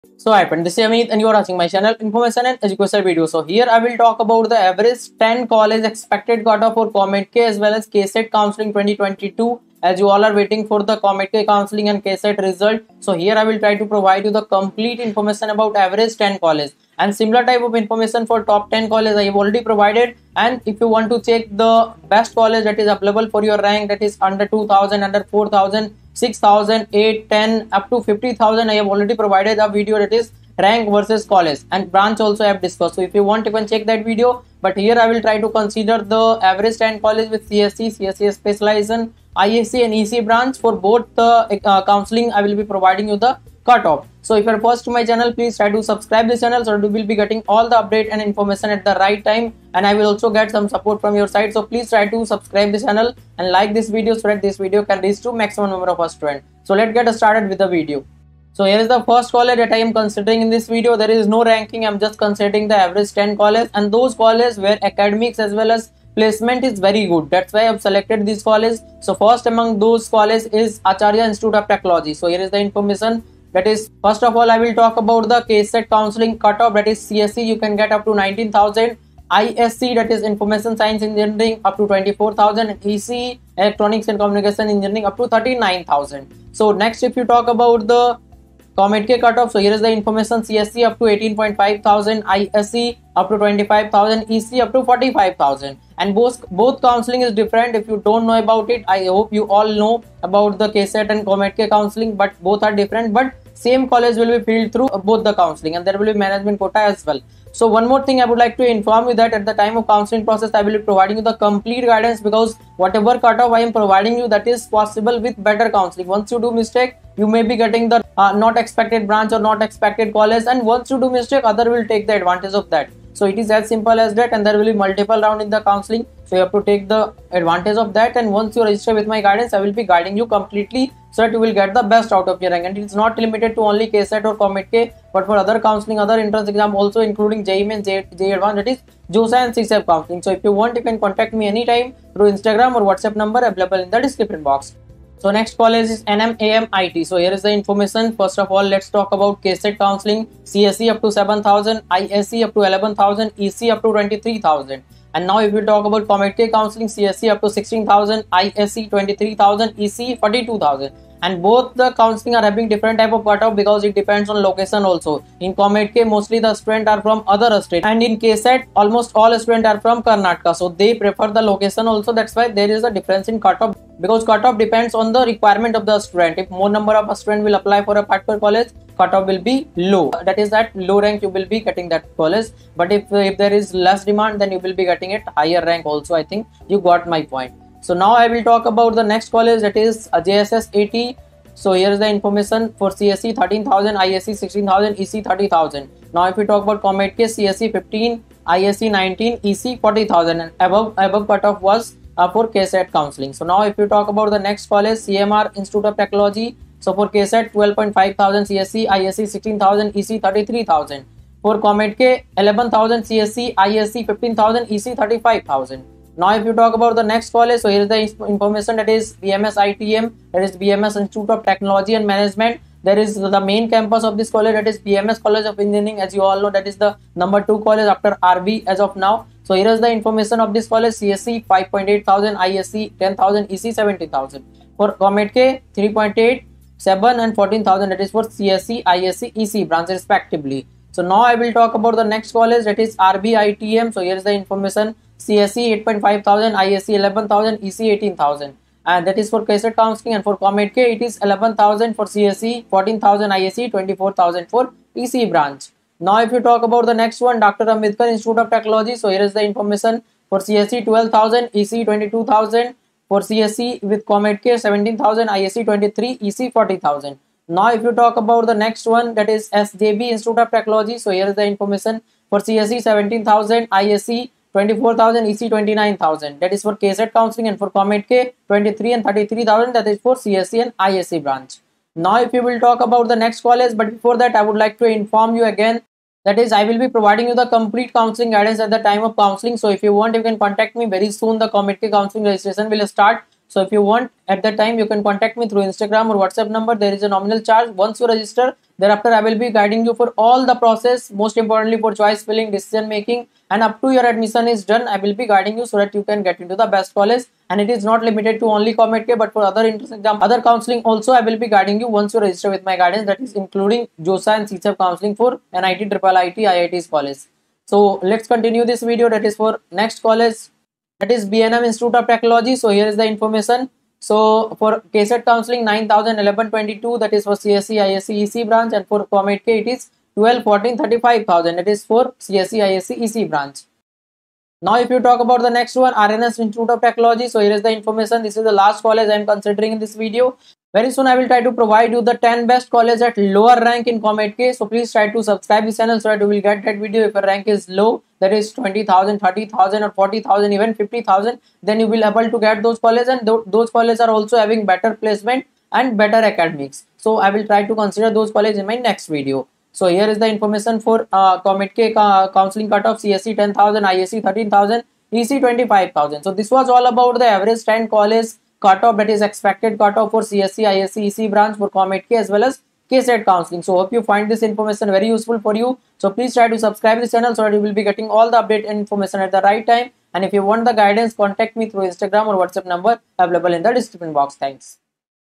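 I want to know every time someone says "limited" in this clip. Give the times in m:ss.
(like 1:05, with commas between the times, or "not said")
2:13, 5:08.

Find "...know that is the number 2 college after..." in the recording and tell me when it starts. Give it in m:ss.
3:46.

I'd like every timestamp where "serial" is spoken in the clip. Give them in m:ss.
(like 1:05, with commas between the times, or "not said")
not said.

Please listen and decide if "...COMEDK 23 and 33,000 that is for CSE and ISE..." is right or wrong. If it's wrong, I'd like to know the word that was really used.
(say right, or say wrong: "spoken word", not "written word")
right.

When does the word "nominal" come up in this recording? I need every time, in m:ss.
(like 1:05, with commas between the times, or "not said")
4:57.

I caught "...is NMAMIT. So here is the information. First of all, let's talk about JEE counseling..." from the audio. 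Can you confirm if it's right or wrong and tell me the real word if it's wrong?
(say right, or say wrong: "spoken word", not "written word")
wrong: "KCET", not "JEE".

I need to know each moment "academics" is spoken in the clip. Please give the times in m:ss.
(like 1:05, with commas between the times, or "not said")
1:04, 5:56.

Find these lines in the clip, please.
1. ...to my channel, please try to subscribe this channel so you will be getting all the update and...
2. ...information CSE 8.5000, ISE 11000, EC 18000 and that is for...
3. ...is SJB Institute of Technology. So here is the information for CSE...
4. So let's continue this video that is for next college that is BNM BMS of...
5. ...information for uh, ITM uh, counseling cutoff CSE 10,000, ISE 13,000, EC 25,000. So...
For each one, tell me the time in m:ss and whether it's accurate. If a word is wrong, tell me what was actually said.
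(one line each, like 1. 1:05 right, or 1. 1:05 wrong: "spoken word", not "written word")
1. 0:44 right
2. 4:04 right
3. 4:29 right
4. 5:17 wrong: "Institute", not "BMS"
5. 6:00 wrong: "COMEDK", not "ITM".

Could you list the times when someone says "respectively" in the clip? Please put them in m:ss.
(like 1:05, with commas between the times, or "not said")
3:59.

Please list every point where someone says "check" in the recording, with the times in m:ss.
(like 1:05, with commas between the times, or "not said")
0:21, 0:33.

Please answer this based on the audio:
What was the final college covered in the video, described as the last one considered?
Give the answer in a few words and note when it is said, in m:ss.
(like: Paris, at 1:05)
RNS Institute of Technology, at 5:35.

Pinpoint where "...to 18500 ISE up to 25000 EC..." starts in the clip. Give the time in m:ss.
1:30.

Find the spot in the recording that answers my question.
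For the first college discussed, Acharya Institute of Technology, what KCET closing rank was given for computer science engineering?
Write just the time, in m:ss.
1:18.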